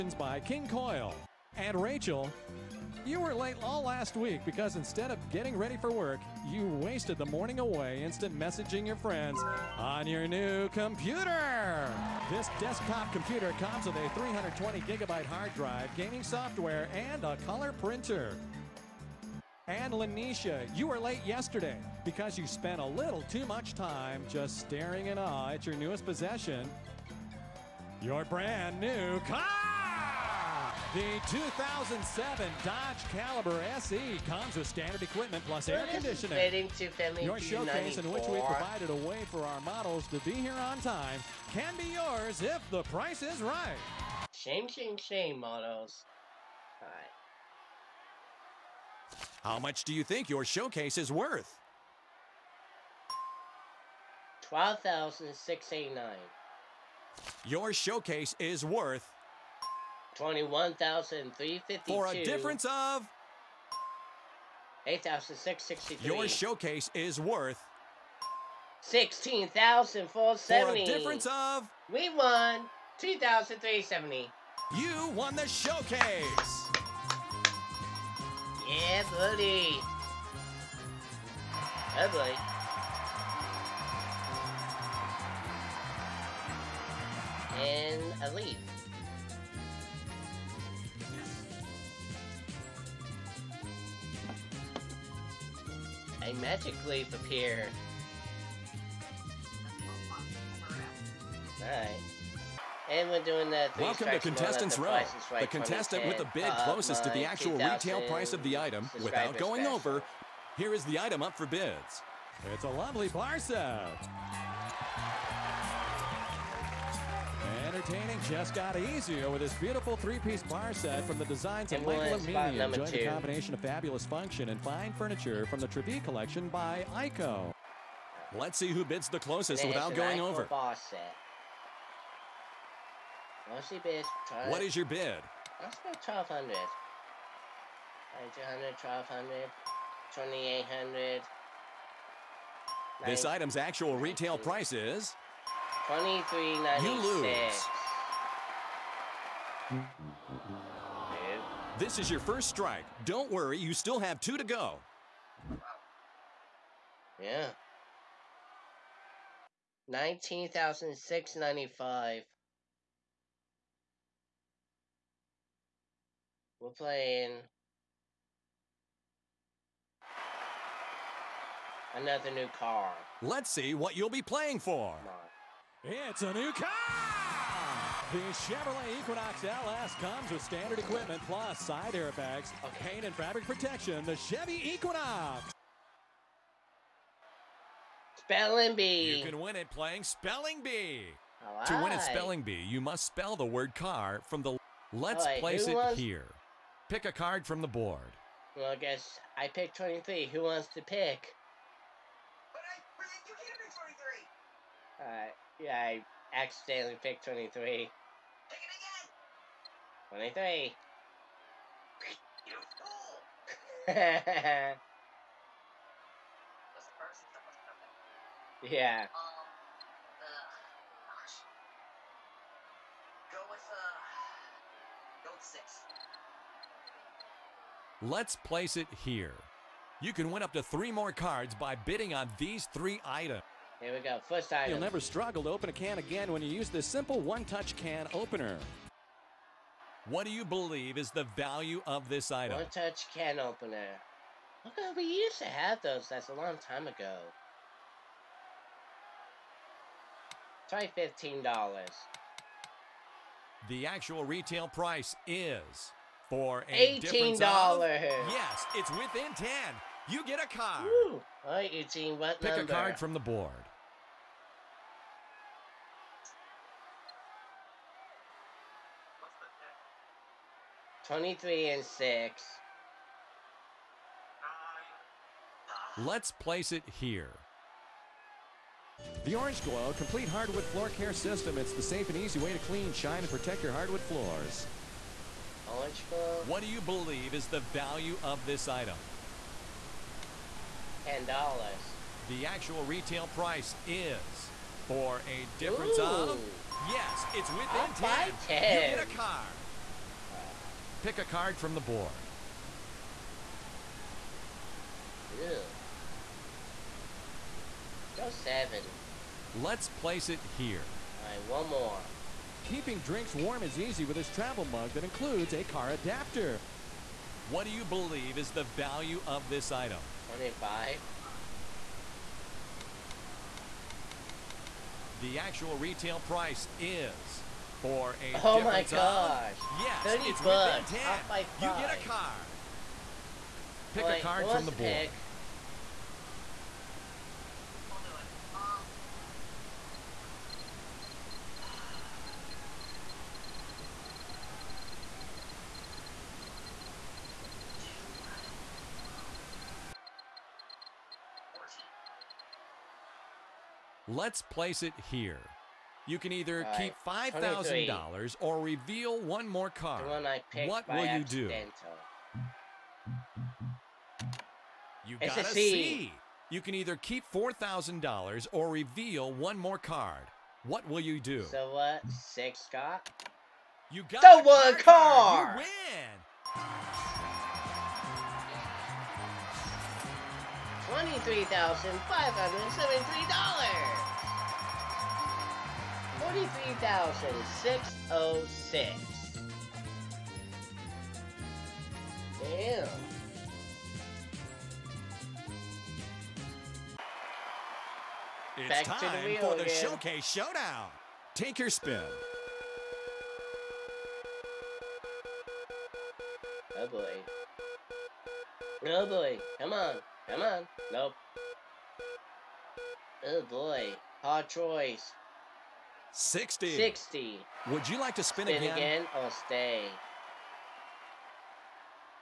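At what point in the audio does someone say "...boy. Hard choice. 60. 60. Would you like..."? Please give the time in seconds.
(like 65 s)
413 s.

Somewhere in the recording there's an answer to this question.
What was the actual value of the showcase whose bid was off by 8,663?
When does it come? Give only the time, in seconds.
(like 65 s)
60 s.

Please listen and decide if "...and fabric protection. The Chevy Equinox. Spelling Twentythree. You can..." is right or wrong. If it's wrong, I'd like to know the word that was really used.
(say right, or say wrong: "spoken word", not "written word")
wrong: "Bee", not "Twentythree".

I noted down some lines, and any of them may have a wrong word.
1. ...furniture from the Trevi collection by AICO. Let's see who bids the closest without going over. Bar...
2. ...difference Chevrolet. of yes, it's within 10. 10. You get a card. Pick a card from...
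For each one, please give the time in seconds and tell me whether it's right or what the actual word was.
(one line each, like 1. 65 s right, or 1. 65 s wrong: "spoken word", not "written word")
1. 124 s right
2. 295 s wrong: "Ooh", not "Chevrolet".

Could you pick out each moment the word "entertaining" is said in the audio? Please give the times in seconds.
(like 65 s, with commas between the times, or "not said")
117 s.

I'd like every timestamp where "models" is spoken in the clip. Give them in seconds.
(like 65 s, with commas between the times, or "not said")
39 s, 45 s.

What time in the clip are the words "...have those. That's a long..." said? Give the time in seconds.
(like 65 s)
245 s.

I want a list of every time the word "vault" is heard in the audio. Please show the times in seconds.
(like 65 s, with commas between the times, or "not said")
not said.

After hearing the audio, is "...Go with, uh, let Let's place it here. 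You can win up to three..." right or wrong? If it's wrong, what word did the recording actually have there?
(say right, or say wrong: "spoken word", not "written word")
right.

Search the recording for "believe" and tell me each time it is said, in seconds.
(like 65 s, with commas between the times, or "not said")
240 s, 286 s, 317 s.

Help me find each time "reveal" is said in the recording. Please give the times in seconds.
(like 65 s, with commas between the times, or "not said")
358 s, 368 s.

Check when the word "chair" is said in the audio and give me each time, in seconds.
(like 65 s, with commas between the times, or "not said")
not said.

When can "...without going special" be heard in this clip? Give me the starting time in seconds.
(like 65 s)
109 s.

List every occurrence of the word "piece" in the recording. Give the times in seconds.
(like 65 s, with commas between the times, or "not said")
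119 s.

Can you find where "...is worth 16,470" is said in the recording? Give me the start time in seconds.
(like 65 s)
66 s.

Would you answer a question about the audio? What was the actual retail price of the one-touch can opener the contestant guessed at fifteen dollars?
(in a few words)
$18.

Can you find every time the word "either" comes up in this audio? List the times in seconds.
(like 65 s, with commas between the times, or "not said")
356 s, 366 s.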